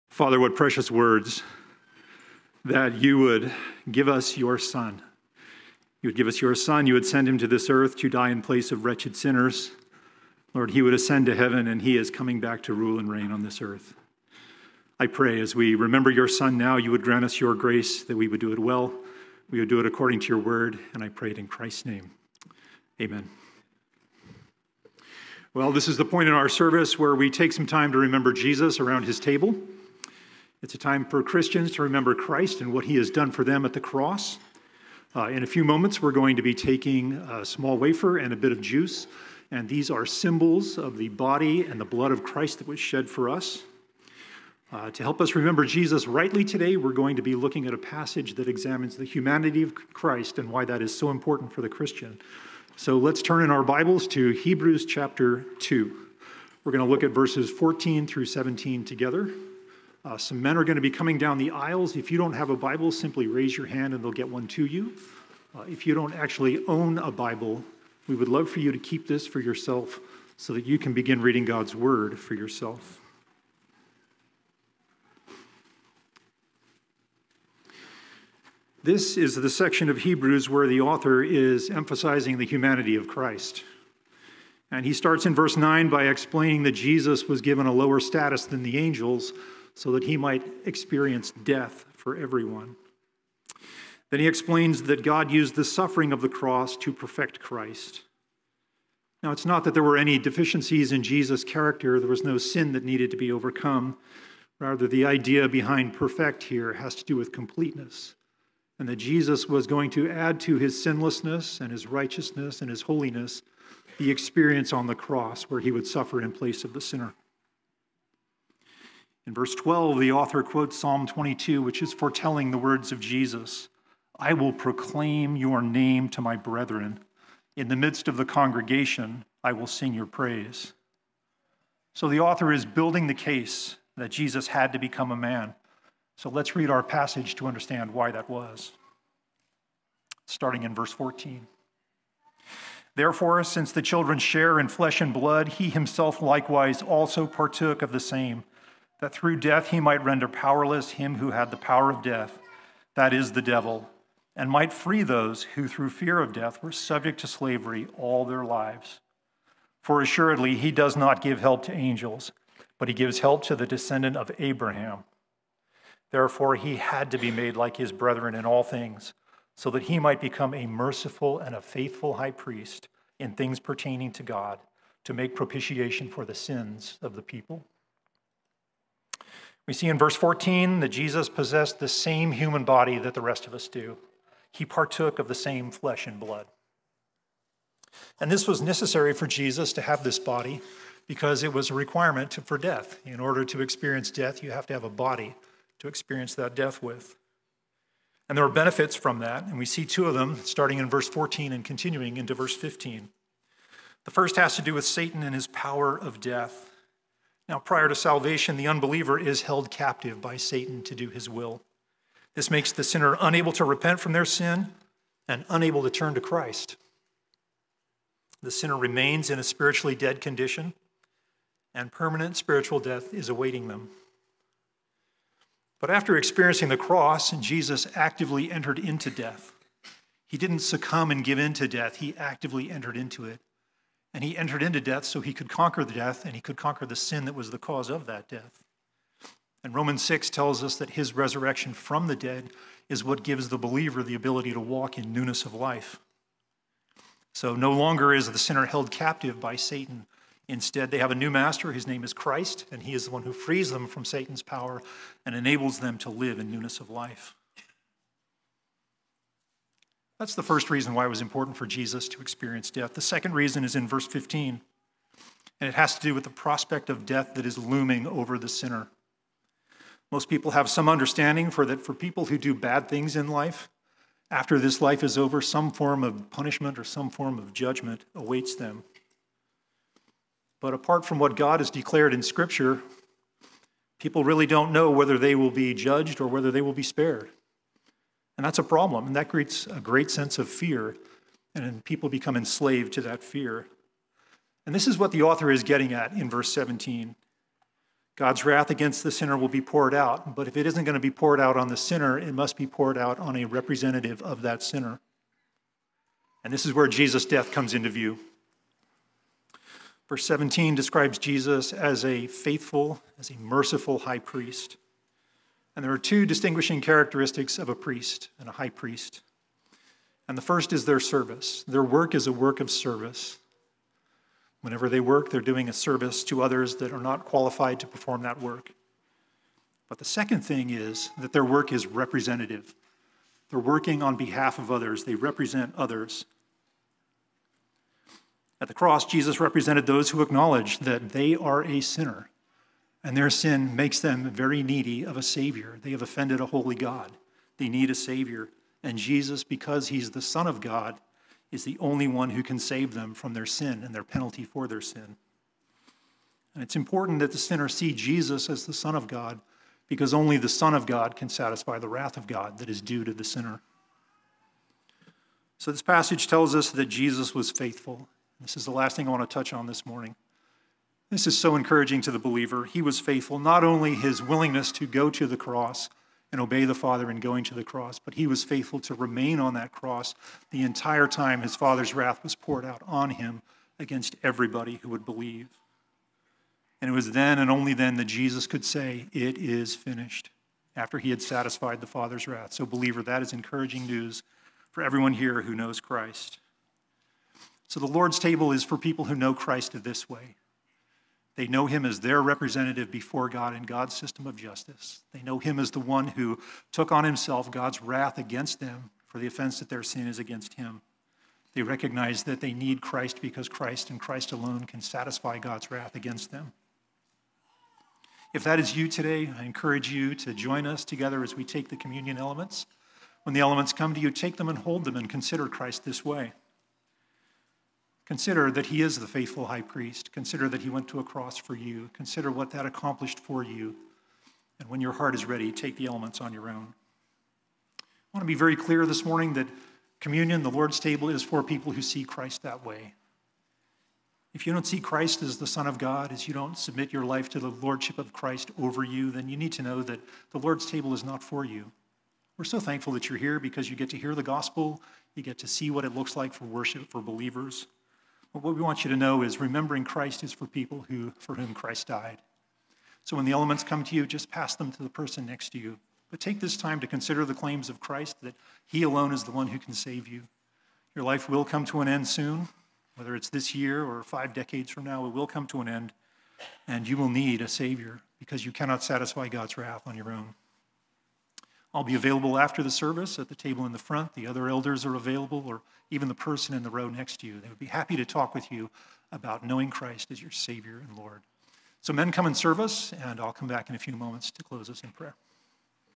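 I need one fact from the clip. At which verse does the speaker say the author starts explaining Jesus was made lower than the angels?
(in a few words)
verse 9.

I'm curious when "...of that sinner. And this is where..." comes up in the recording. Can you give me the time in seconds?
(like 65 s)
304 s.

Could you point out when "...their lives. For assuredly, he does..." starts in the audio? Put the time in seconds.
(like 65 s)
158 s.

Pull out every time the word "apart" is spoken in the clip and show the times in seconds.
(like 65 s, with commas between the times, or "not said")
280 s.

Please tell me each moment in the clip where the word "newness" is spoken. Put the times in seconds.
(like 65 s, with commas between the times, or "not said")
245 s, 256 s.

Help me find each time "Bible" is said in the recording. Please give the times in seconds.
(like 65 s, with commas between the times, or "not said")
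53 s, 62 s, 67 s.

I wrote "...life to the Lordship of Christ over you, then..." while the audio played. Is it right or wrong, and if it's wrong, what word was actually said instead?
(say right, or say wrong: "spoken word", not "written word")
right.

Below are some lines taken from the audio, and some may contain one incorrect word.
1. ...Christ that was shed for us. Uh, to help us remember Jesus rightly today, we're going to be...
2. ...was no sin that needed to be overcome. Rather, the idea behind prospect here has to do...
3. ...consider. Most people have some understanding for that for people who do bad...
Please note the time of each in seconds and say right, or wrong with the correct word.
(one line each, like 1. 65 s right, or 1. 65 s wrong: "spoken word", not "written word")
1. 42 s right
2. 102 s wrong: "perfect", not "prospect"
3. 268 s wrong: "sinner", not "consider".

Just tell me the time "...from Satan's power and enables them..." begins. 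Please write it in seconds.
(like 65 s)
253 s.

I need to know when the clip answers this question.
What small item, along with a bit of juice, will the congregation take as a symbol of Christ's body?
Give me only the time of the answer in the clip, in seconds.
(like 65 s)
37 s.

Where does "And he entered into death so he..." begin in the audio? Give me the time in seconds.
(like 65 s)
234 s.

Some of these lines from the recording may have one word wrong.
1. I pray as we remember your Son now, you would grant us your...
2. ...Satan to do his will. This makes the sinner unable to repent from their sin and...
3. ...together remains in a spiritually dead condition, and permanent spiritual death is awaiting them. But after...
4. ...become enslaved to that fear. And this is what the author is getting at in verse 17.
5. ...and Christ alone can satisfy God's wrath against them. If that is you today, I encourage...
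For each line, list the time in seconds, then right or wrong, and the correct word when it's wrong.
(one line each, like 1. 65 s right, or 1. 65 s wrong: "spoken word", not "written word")
1. 14 s right
2. 210 s right
3. 218 s wrong: "sinner", not "together"
4. 292 s right
5. 413 s right.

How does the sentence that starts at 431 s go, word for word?
Consider what that accomplished for you.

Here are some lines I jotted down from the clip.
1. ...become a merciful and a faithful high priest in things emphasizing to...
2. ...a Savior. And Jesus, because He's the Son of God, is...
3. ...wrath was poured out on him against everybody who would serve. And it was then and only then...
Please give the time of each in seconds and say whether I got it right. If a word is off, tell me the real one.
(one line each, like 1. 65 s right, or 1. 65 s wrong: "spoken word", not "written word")
1. 170 s wrong: "pertaining", not "emphasizing"
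2. 347 s right
3. 381 s wrong: "believe", not "serve".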